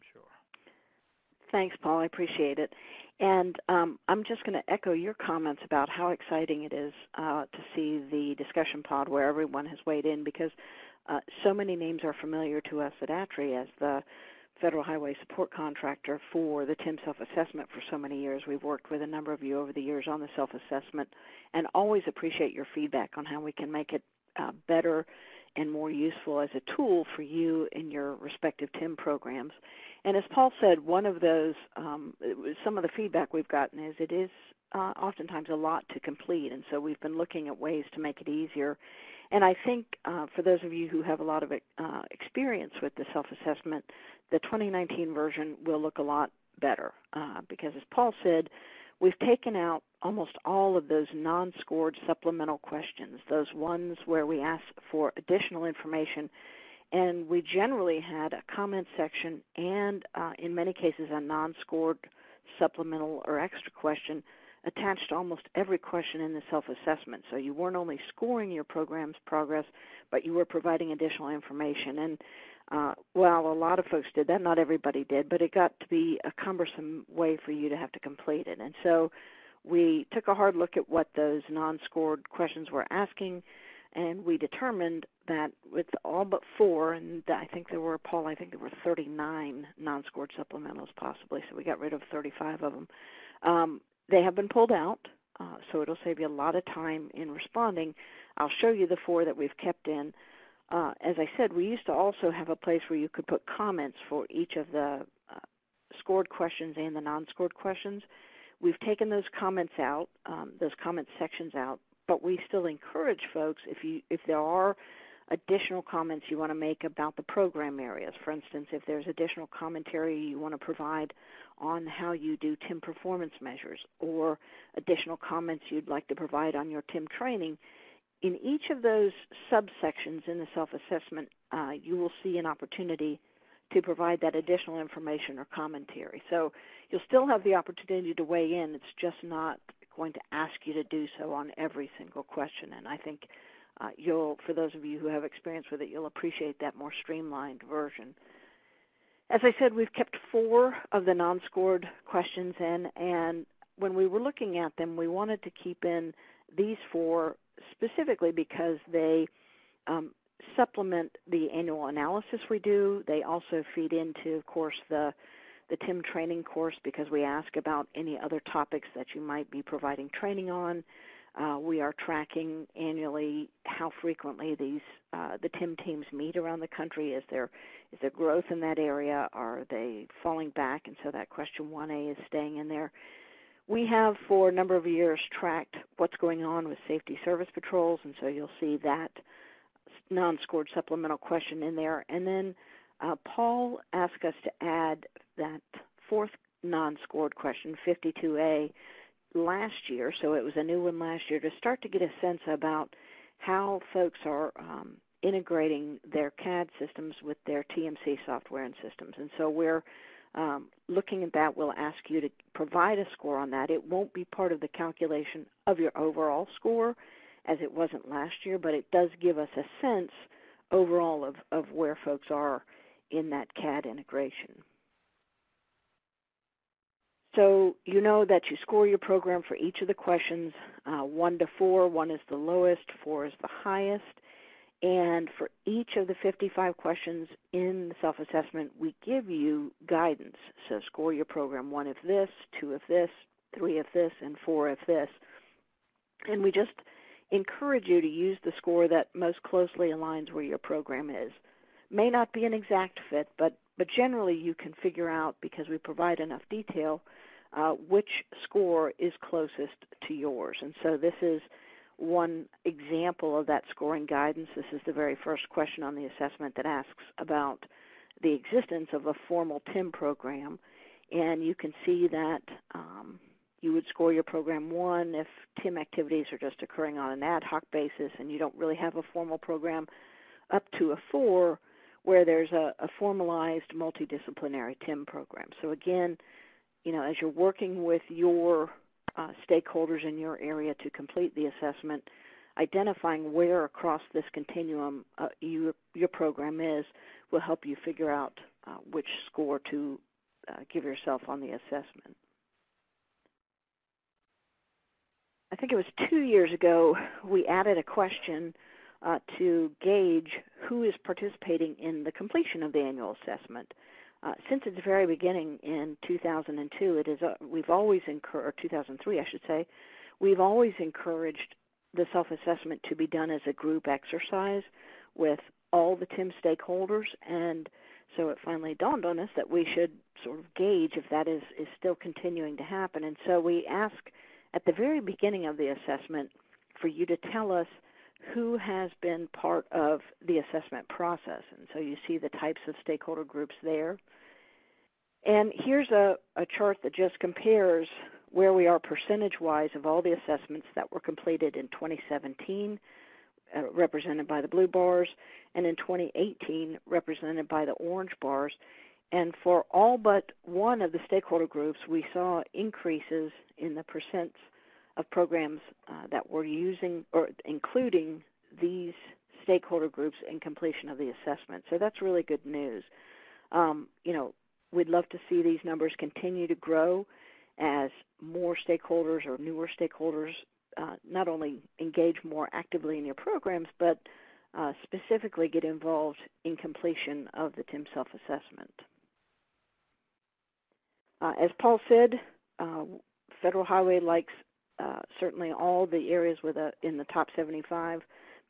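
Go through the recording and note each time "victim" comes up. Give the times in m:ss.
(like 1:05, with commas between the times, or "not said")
not said.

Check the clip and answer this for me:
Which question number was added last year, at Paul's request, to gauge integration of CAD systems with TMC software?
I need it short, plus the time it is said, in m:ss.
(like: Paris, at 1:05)
52A, at 3:17.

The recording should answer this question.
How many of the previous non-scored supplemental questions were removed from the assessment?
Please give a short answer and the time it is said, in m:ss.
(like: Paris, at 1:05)
35, at 1:32.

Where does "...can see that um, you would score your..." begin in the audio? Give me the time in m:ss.
4:31.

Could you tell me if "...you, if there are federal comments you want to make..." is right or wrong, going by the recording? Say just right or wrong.
wrong.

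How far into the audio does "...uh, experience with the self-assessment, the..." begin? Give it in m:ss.
0:41.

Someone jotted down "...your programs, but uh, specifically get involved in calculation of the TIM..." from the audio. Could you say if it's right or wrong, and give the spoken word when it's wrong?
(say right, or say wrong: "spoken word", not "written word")
wrong: "completion", not "calculation".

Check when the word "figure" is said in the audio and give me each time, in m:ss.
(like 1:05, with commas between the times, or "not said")
4:14, 4:57.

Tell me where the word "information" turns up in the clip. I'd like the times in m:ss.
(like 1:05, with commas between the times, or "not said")
0:55, 1:11, 2:14.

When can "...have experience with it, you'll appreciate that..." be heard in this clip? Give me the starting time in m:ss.
2:25.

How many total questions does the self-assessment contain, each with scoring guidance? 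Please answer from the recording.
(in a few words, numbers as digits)
55.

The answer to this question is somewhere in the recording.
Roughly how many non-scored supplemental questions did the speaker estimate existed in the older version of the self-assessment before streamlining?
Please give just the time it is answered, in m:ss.
1:28.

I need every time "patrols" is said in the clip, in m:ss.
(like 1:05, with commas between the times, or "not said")
3:07.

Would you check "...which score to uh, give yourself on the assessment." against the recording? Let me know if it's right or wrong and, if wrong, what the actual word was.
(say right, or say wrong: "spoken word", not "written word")
right.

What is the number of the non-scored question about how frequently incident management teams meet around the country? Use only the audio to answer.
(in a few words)
1A.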